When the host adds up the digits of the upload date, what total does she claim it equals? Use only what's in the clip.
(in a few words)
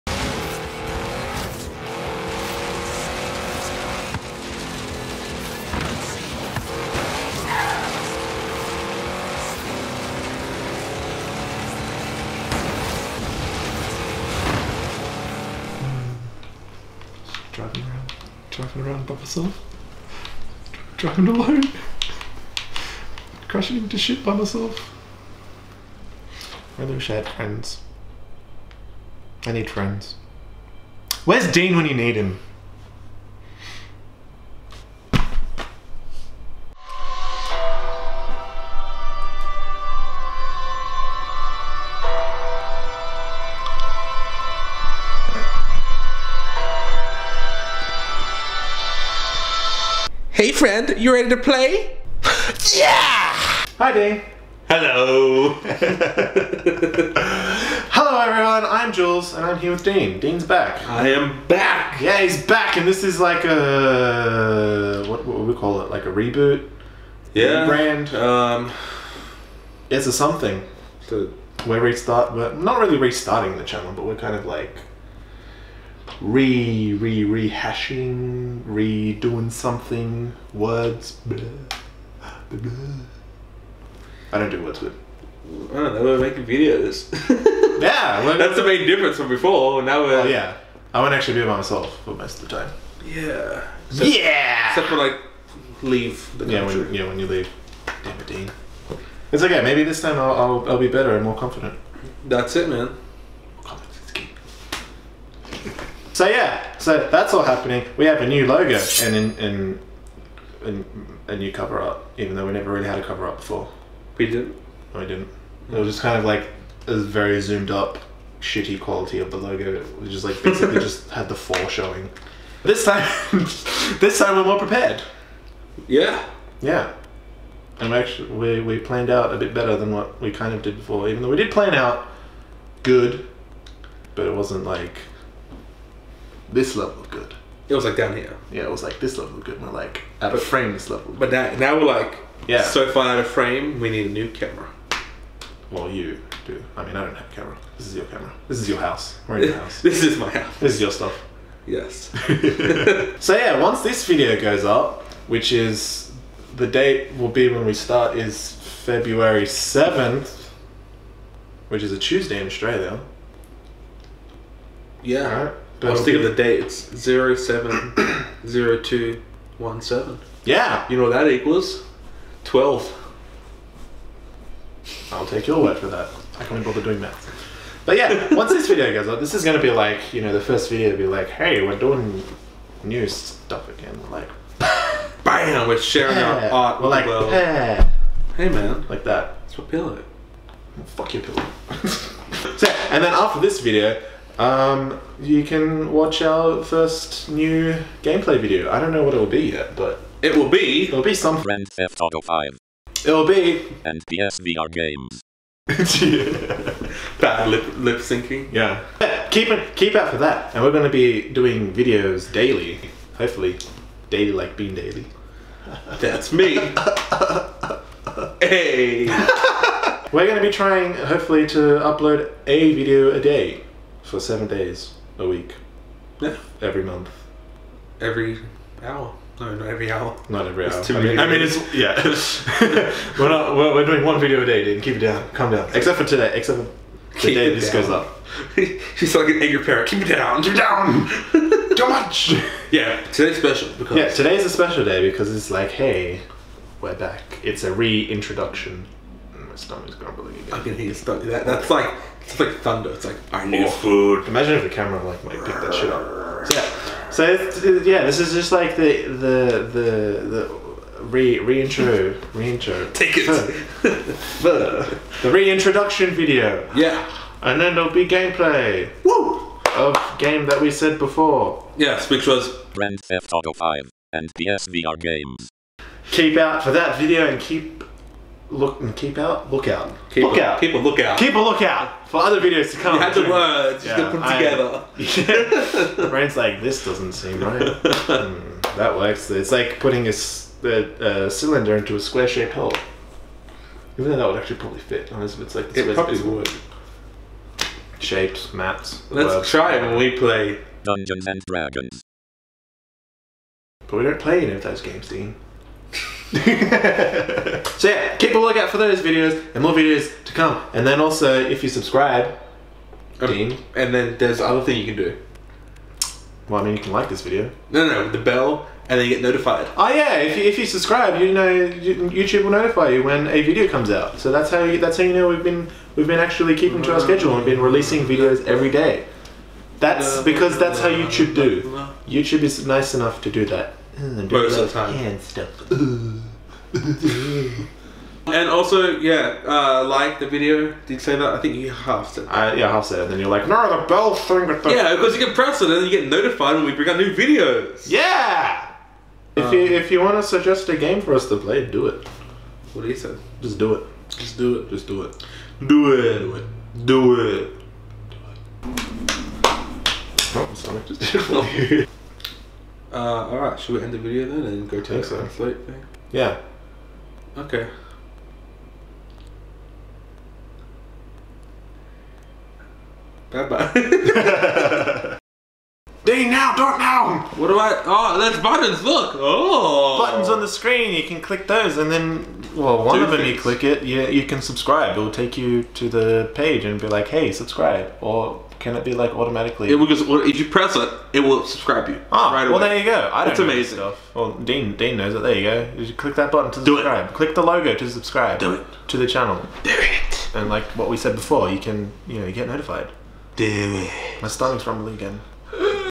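12.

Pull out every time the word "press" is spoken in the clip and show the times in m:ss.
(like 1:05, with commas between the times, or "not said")
5:45, 6:30.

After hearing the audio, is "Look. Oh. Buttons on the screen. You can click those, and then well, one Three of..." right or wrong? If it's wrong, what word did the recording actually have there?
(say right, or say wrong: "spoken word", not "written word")
wrong: "Two", not "Three".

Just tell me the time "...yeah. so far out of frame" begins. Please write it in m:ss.
2:22.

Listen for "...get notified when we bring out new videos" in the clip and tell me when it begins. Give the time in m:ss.
5:45.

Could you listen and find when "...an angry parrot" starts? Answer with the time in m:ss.
3:59.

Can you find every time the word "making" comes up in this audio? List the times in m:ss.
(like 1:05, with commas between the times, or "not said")
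1:26.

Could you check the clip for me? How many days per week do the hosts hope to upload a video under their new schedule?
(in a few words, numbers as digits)
7.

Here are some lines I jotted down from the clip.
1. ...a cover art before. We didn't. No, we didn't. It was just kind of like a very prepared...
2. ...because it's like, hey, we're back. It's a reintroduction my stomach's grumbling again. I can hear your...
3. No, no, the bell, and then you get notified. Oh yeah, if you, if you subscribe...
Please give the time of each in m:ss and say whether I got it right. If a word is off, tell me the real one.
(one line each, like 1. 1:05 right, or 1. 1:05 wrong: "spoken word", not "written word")
1. 1:52 wrong: "zoomed", not "prepared"
2. 4:05 right
3. 5:17 right.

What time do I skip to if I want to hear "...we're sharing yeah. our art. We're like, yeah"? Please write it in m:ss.
3:05.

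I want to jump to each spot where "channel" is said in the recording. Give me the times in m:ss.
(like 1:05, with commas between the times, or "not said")
1:13, 6:39.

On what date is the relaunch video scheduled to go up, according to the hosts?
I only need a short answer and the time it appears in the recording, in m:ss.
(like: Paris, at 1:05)
February 7, at 2:38.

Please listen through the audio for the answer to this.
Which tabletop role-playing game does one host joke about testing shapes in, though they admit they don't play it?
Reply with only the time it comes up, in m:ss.
5:00.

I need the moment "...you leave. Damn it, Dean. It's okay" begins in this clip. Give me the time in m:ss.
1:37.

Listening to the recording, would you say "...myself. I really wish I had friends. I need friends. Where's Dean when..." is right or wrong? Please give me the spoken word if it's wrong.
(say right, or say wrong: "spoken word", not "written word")
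right.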